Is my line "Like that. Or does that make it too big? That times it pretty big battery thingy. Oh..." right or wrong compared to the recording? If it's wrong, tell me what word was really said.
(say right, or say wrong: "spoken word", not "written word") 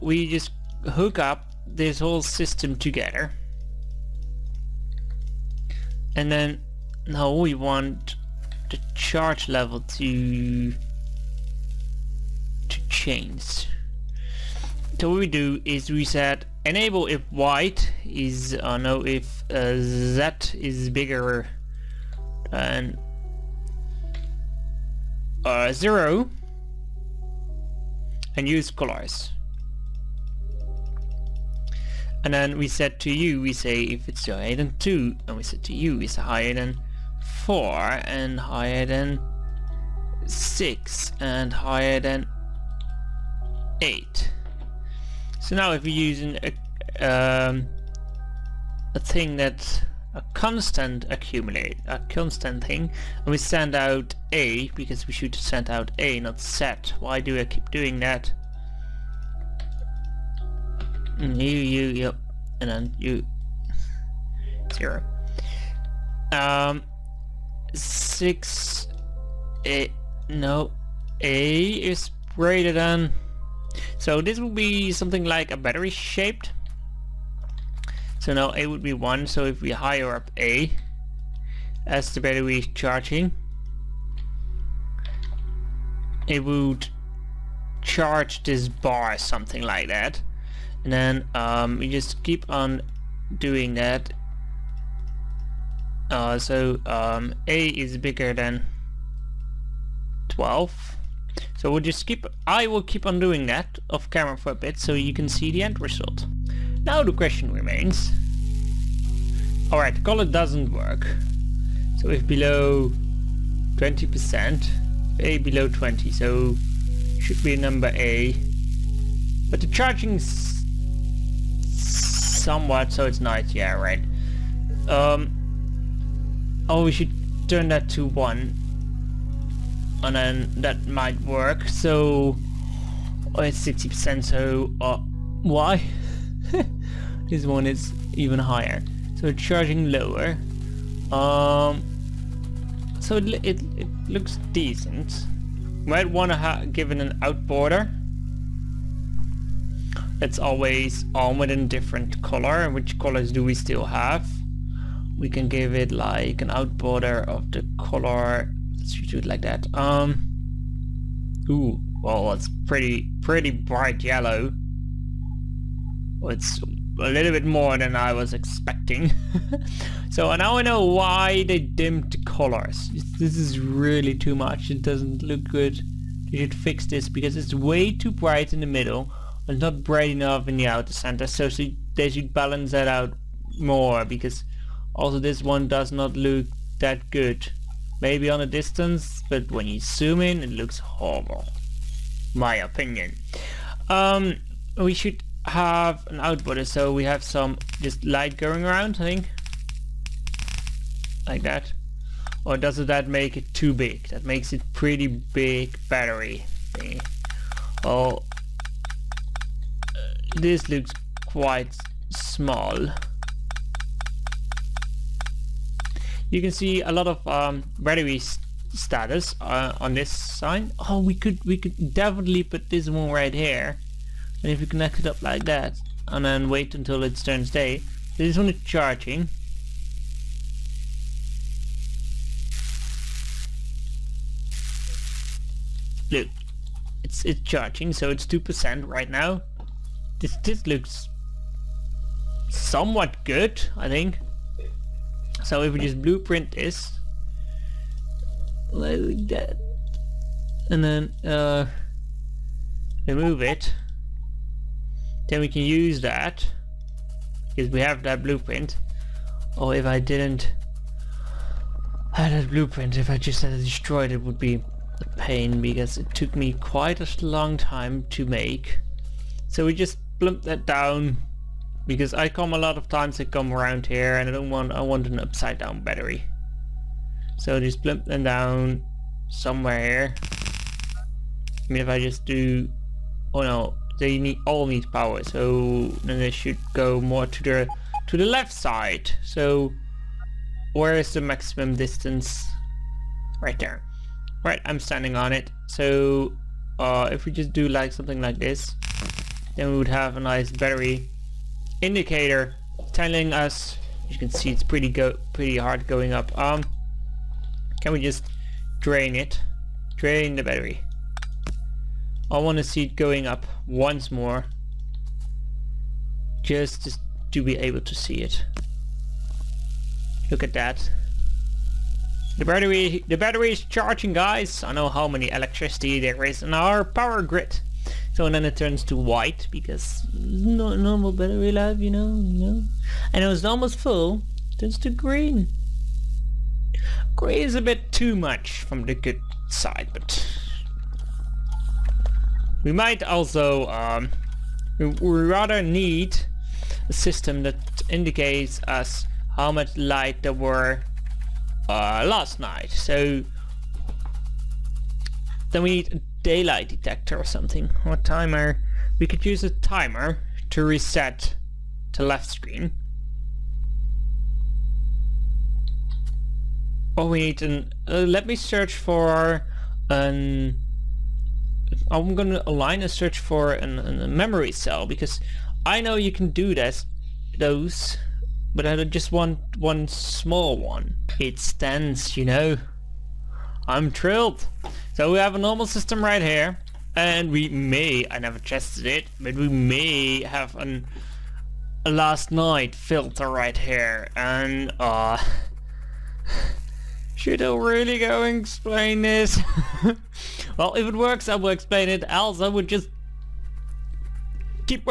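wrong: "makes", not "times".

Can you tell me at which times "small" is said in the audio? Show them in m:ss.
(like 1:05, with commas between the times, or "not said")
3:32, 6:19.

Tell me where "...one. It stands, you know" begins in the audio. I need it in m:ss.
6:20.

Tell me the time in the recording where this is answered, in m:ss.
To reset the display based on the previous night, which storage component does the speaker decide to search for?
6:14.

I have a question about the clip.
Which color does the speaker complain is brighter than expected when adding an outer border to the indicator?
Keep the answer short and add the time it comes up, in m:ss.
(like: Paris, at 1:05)
Yellow, at 2:43.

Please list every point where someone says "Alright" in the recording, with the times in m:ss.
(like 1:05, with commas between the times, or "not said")
1:49.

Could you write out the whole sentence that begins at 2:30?
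It's always on with a different color.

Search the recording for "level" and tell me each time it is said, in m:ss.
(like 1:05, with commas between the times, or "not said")
0:09.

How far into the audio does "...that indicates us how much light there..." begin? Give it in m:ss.
5:47.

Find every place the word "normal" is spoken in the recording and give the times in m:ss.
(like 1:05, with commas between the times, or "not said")
5:30, 6:25.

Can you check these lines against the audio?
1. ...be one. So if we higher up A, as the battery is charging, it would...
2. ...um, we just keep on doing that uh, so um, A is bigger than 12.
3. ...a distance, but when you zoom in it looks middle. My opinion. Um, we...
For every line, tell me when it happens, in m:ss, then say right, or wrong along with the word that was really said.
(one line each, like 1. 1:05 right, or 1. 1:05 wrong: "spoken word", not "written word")
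1. 1:18 right
2. 1:31 right
3. 3:08 wrong: "horrible", not "middle".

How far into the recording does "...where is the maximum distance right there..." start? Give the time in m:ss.
4:50.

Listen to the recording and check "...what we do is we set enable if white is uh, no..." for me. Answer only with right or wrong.
right.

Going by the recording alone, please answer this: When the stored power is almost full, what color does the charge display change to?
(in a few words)
Green.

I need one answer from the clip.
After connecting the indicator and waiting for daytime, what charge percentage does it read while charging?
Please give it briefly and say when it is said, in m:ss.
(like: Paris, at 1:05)
2%, at 3:58.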